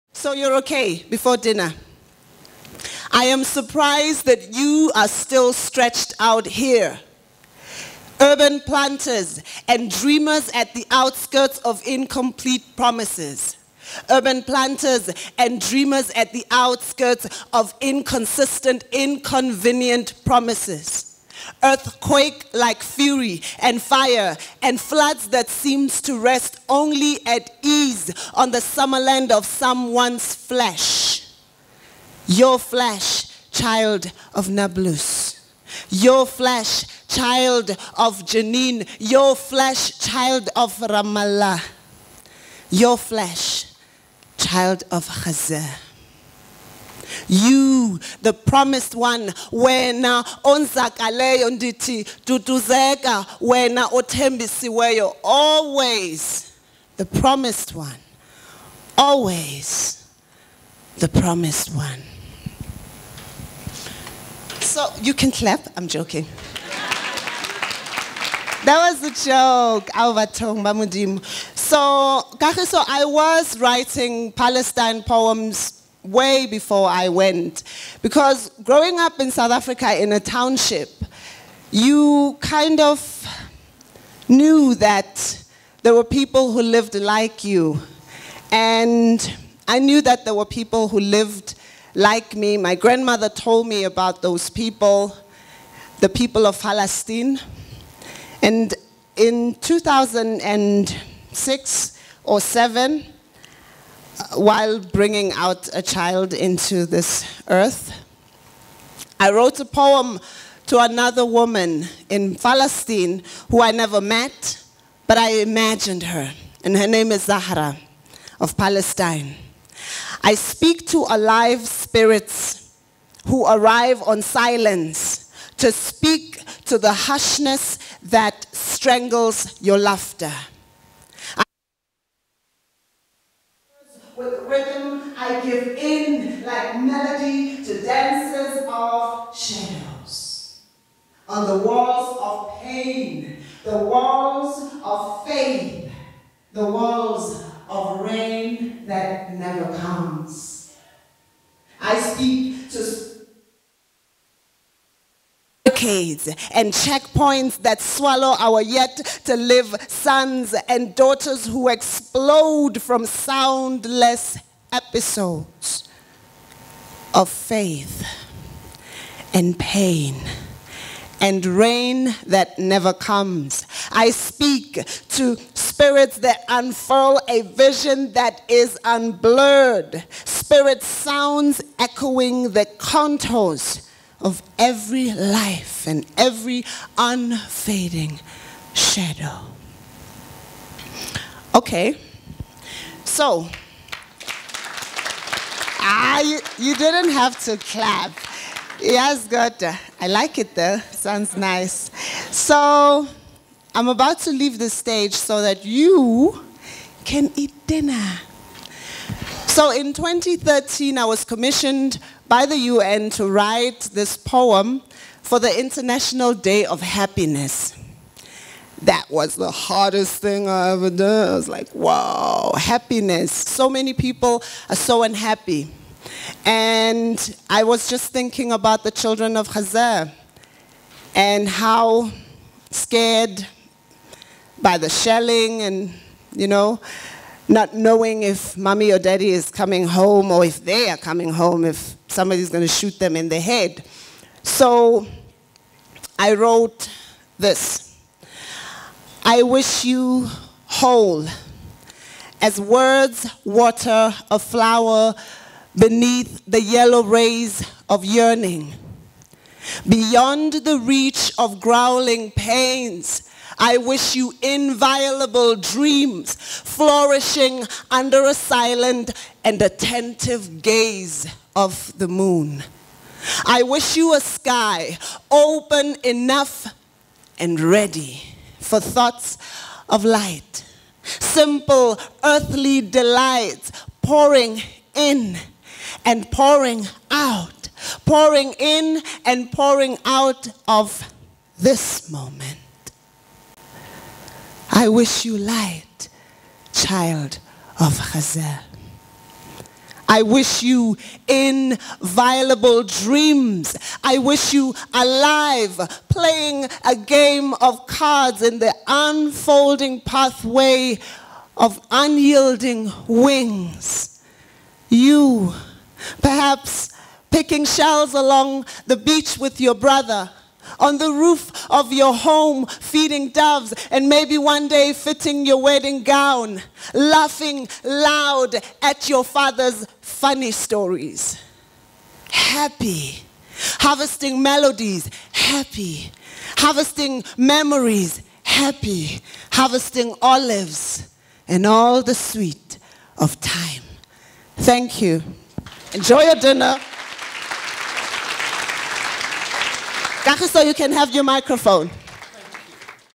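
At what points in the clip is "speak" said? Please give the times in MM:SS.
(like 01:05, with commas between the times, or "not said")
02:00, 02:05, 02:31, 02:54.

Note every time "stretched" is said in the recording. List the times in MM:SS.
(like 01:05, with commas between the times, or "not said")
00:05.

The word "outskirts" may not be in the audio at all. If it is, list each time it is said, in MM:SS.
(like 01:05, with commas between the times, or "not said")
00:10, 00:16.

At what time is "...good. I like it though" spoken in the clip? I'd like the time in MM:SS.
03:19.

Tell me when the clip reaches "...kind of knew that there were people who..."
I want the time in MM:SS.
01:22.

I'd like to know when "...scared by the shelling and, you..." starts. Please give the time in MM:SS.
03:52.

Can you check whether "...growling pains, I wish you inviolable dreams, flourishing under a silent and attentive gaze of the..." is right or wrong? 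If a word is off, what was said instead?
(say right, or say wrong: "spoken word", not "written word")
right.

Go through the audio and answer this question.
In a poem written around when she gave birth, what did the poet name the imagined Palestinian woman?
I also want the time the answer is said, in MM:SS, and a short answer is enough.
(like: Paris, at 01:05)
Zahra, at 01:57.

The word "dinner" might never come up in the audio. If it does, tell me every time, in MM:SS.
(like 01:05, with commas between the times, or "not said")
00:01, 03:27, 05:46.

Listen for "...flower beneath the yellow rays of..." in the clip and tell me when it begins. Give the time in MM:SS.
04:14.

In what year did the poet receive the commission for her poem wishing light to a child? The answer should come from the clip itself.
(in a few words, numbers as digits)
2013.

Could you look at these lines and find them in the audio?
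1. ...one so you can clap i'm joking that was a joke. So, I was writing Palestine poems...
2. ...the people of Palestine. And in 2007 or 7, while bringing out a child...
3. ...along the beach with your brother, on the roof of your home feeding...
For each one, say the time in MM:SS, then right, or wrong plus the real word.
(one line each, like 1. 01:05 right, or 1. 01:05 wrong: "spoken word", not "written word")
1. 01:01 right
2. 01:35 wrong: "2006", not "2007"
3. 05:18 right.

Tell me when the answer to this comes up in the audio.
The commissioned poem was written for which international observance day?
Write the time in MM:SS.
03:35.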